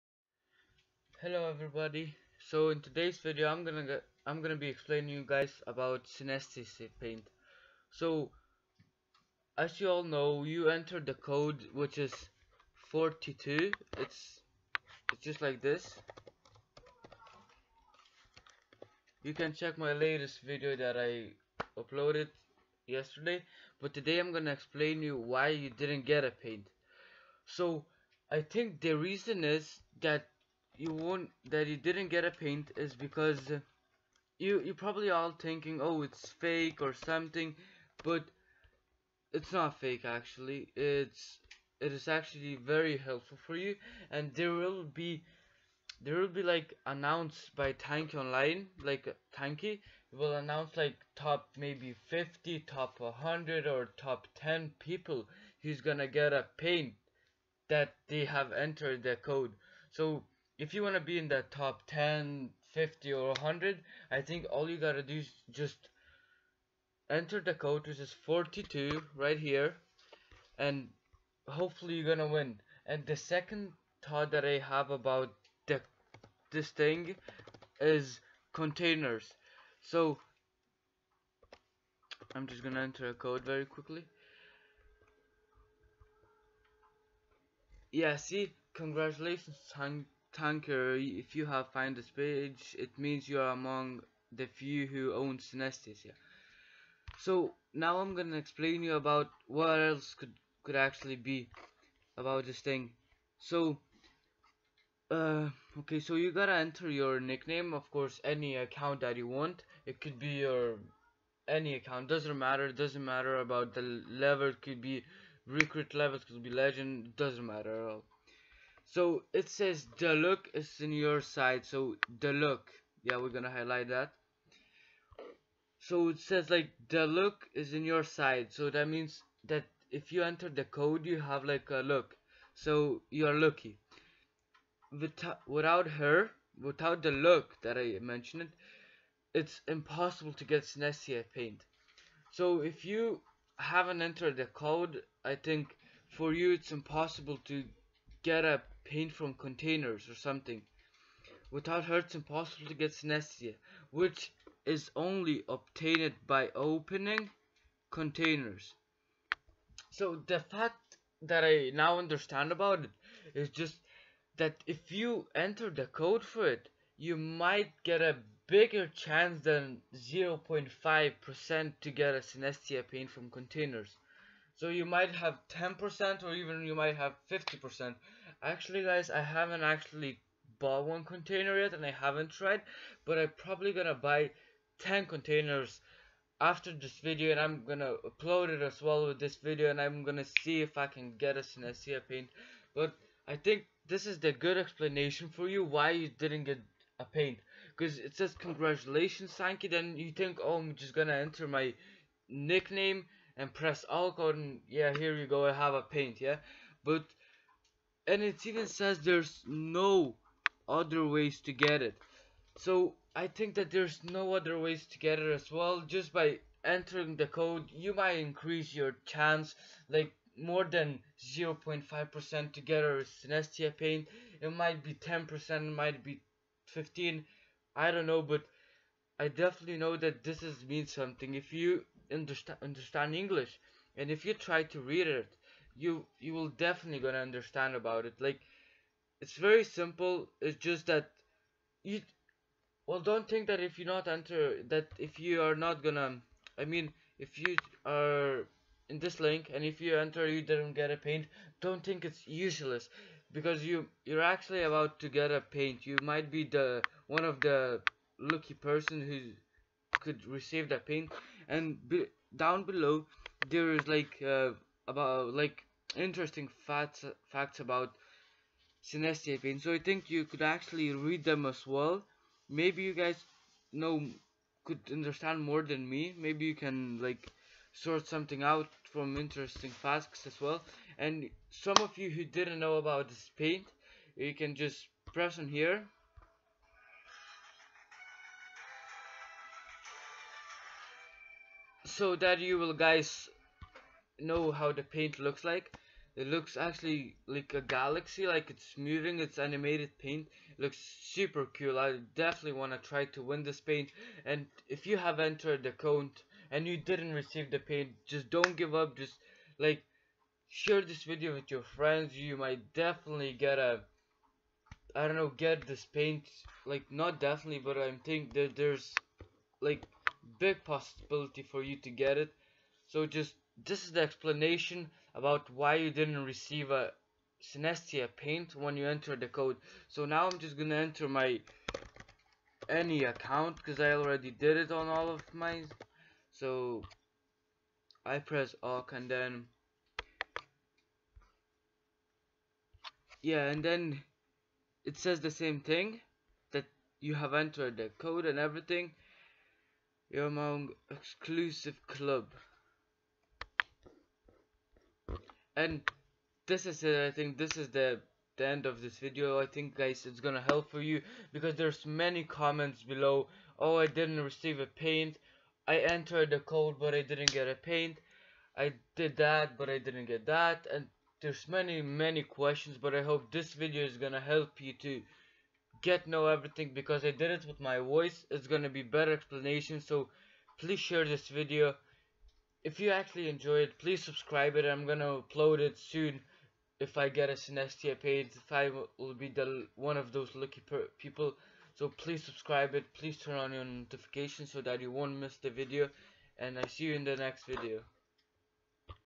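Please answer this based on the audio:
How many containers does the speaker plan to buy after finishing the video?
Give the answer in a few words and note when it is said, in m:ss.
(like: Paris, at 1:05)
10, at 3:04.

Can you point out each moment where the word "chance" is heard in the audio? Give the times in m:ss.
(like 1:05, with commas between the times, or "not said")
2:48, 3:39.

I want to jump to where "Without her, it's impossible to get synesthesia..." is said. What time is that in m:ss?
2:31.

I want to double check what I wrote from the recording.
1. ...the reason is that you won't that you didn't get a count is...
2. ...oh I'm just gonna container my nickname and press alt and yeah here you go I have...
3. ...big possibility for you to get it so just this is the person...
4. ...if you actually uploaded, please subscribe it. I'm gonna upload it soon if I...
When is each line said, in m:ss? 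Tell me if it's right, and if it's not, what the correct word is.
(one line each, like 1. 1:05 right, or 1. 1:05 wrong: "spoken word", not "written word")
1. 0:28 wrong: "paint", not "count"
2. 3:20 wrong: "enter", not "container"
3. 5:20 wrong: "explanation", not "person"
4. 6:22 wrong: "enjoyed", not "uploaded".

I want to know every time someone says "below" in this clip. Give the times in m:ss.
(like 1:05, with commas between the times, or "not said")
4:22, 6:02.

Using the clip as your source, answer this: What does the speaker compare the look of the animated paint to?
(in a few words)
a galaxy.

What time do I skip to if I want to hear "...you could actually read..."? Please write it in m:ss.
4:30.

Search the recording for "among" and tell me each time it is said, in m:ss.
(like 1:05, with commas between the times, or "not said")
1:33, 5:50.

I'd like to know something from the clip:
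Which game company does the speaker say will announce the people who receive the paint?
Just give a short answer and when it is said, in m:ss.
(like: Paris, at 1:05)
Tanki Online, at 0:47.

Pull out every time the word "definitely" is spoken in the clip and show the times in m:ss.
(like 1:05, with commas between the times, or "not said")
3:49, 3:56, 5:02, 5:12, 5:17.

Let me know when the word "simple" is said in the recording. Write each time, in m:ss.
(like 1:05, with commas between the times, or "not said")
3:59.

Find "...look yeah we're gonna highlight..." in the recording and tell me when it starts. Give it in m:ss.
2:02.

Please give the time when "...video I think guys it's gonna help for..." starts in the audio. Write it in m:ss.
5:58.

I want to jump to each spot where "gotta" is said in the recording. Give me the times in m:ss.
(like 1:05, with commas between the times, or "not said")
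1:04, 1:46.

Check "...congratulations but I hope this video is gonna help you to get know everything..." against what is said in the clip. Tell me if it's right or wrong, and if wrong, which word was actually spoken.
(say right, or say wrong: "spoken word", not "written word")
wrong: "questions", not "congratulations".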